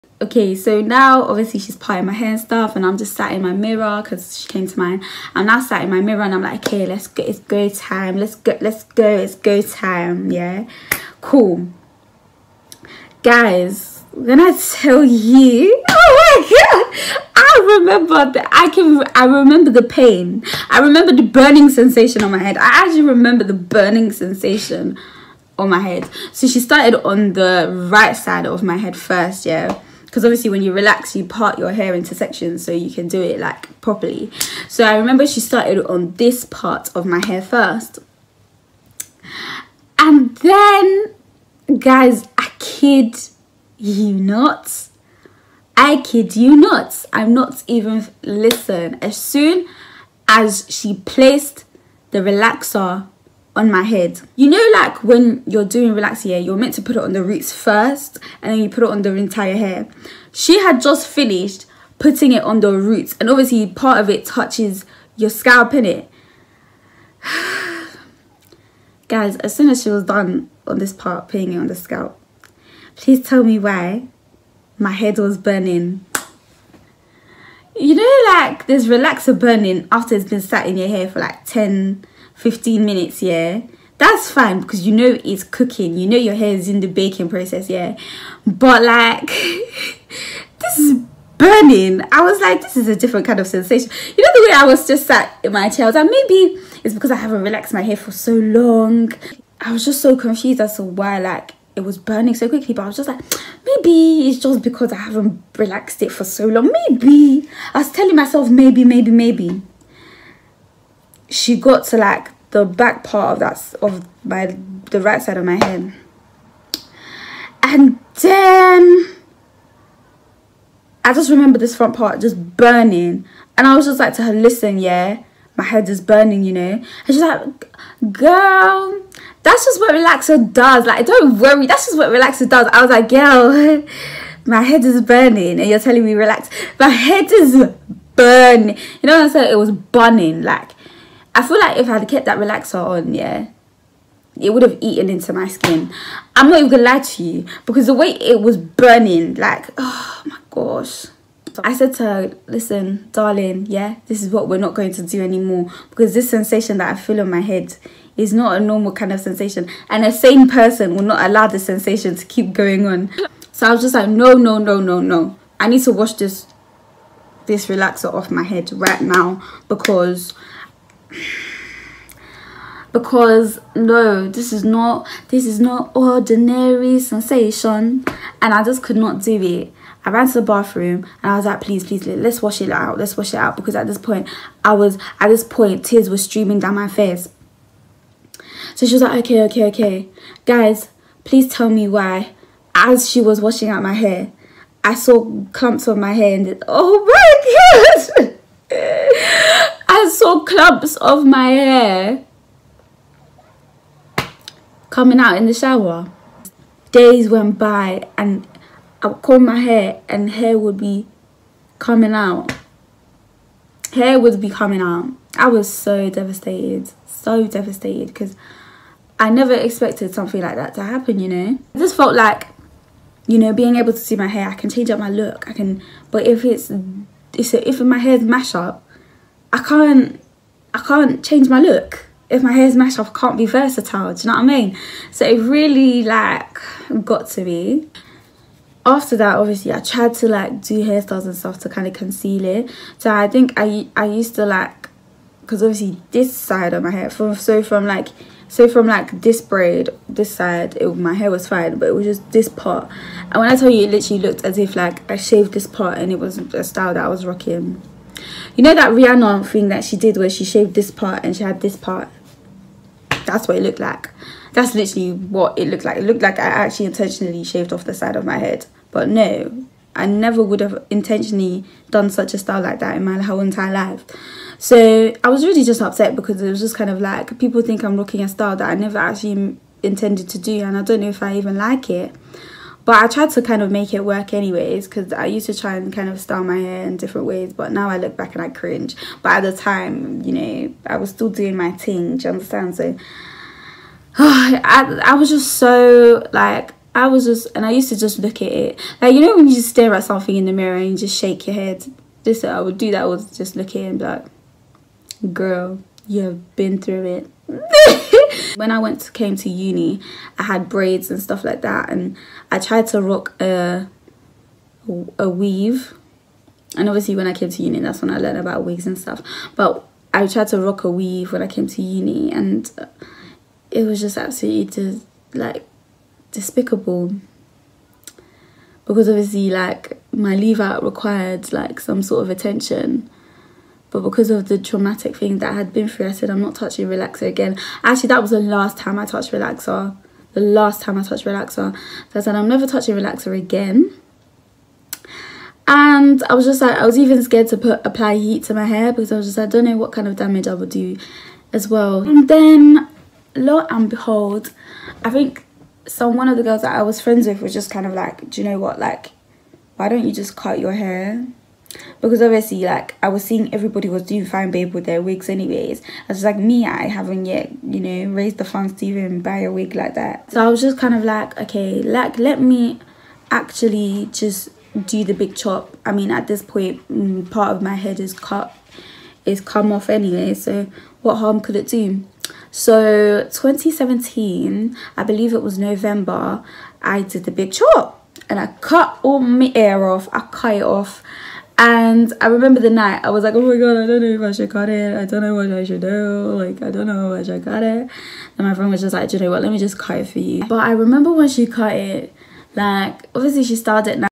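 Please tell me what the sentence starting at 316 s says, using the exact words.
And obviously, when I came to uni, that's when I learned about wigs and stuff.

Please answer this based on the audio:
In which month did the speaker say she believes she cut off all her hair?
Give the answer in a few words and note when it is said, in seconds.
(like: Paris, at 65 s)
November, at 385 s.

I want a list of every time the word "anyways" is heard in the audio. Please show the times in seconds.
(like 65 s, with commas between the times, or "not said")
284 s, 365 s, 379 s.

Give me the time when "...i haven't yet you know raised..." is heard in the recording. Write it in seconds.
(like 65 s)
366 s.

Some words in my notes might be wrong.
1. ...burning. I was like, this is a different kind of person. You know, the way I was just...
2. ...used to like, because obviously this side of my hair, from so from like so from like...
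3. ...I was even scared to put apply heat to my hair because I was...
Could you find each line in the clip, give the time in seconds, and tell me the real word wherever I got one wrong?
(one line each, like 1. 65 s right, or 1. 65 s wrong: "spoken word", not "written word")
1. 91 s wrong: "sensation", not "person"
2. 244 s right
3. 346 s right.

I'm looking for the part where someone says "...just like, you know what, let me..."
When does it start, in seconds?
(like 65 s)
398 s.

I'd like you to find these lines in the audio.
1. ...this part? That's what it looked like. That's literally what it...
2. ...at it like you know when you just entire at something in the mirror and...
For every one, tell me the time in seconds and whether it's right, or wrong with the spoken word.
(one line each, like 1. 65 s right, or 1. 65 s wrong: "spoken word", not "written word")
1. 261 s right
2. 298 s wrong: "stare", not "entire".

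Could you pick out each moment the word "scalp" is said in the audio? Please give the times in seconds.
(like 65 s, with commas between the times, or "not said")
65 s, 71 s.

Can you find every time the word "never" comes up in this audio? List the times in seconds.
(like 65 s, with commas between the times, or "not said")
219 s, 270 s, 278 s, 342 s.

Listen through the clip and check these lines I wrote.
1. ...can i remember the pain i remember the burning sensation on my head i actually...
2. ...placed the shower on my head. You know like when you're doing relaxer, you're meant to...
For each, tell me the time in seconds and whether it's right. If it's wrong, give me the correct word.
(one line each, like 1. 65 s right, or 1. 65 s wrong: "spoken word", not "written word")
1. 18 s right
2. 51 s wrong: "relaxer", not "shower".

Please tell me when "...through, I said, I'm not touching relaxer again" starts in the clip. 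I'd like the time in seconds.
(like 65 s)
335 s.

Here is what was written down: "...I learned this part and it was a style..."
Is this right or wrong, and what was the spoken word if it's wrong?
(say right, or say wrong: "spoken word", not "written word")
wrong: "shaved", not "learned".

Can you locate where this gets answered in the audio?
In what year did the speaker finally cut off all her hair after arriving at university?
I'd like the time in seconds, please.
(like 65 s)
383 s.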